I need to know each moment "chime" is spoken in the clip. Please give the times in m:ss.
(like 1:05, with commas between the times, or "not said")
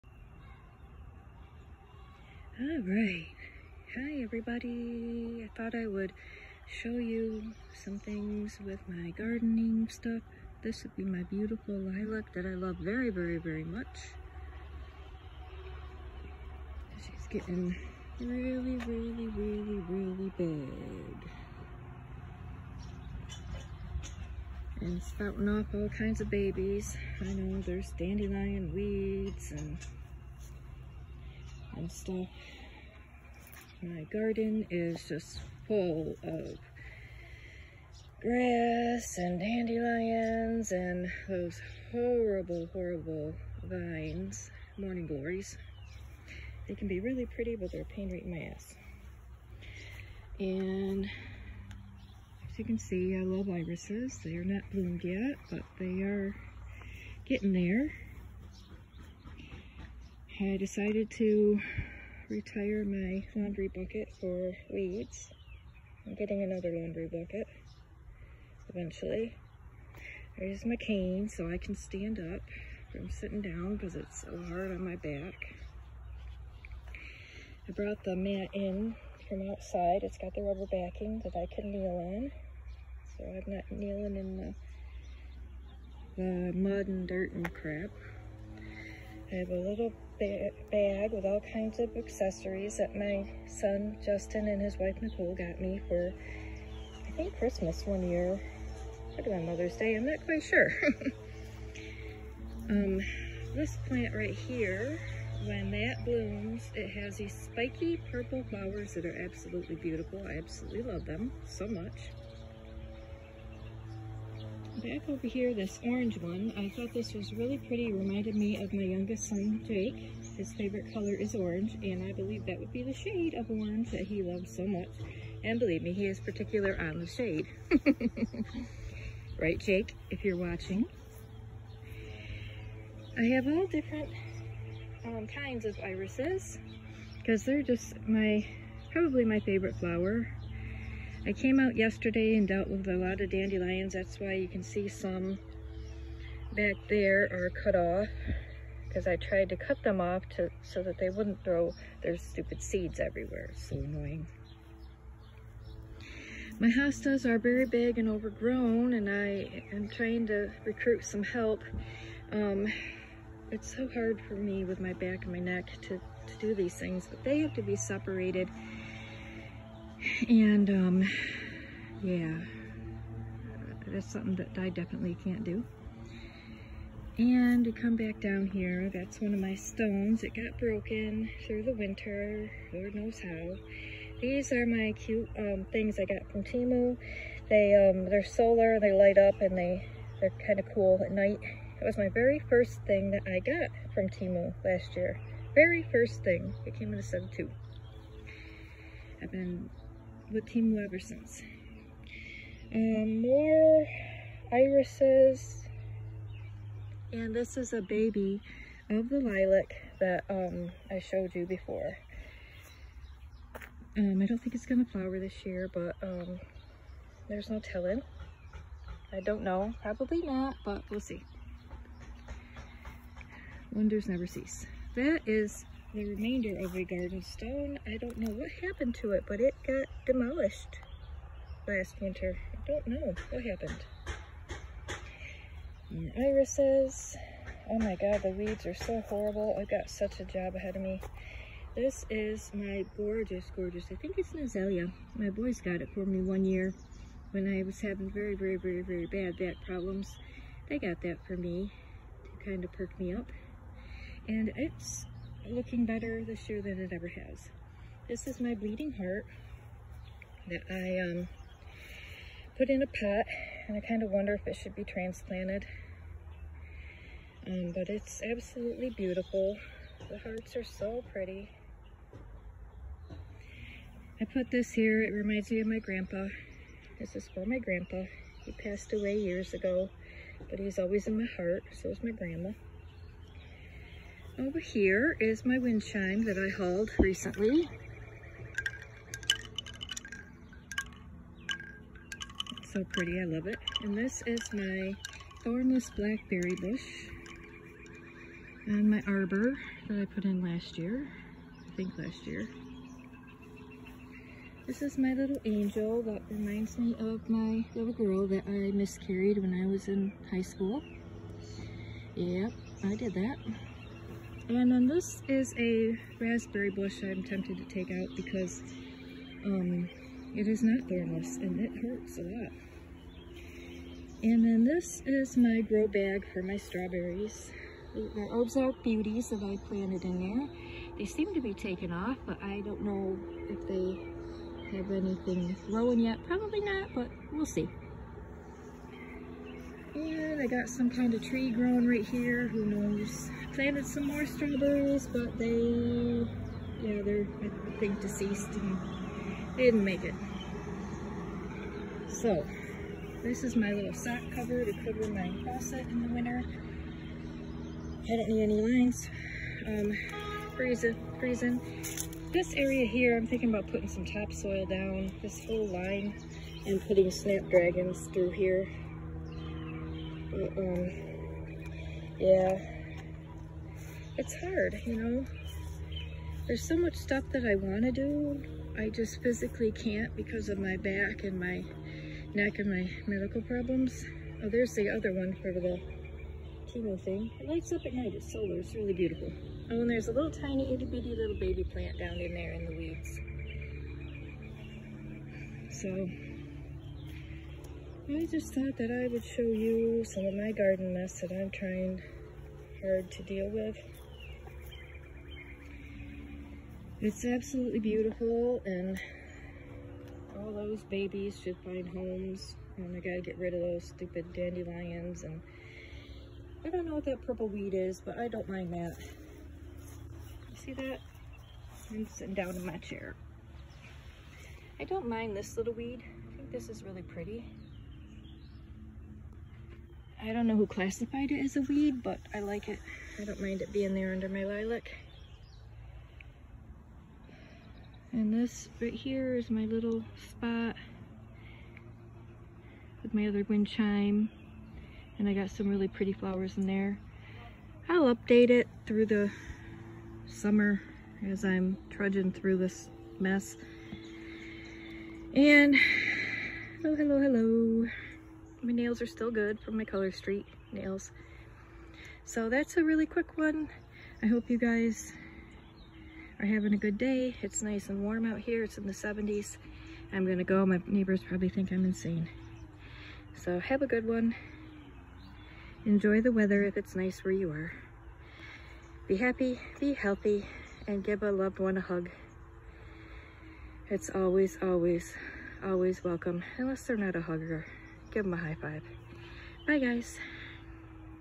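4:45, 7:23.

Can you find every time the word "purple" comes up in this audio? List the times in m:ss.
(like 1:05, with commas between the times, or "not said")
1:48, 6:57.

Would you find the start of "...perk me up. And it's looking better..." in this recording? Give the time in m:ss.
4:12.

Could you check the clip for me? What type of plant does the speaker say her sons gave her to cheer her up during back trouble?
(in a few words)
Azalea.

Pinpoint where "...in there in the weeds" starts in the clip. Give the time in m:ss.
6:32.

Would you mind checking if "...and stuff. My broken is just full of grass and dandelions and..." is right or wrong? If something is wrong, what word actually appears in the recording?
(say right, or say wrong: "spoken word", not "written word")
wrong: "garden", not "broken".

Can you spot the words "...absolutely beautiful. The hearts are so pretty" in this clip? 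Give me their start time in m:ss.
4:28.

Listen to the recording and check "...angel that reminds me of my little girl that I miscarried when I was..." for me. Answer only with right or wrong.
right.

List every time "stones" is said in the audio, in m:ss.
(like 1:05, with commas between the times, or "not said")
2:59, 3:47.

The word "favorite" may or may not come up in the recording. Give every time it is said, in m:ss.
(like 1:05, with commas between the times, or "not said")
2:00, 2:19.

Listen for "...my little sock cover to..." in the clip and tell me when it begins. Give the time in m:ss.
5:53.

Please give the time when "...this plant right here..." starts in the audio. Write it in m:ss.
1:43.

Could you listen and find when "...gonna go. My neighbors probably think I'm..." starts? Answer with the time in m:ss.
7:50.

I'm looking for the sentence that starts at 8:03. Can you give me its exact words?
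It's always, always, always welcome, unless they're not a hugger.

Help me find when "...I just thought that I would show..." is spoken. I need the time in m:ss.
6:38.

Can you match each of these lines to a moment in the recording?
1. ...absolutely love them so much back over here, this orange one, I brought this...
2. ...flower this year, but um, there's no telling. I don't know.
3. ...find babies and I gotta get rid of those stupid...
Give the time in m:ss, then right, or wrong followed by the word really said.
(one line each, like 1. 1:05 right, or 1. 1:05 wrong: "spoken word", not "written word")
1. 1:50 wrong: "thought", not "brought"
2. 3:34 right
3. 6:51 wrong: "homes", not "babies".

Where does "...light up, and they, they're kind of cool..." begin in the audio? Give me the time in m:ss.
3:08.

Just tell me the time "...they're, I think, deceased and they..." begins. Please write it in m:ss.
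5:47.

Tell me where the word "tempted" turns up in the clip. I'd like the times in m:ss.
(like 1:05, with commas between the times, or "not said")
5:17.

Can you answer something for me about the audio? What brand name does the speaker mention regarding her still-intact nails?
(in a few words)
Color Street.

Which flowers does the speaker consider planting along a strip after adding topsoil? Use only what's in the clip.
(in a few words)
Snapdragons.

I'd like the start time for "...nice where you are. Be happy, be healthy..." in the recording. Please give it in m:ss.
7:56.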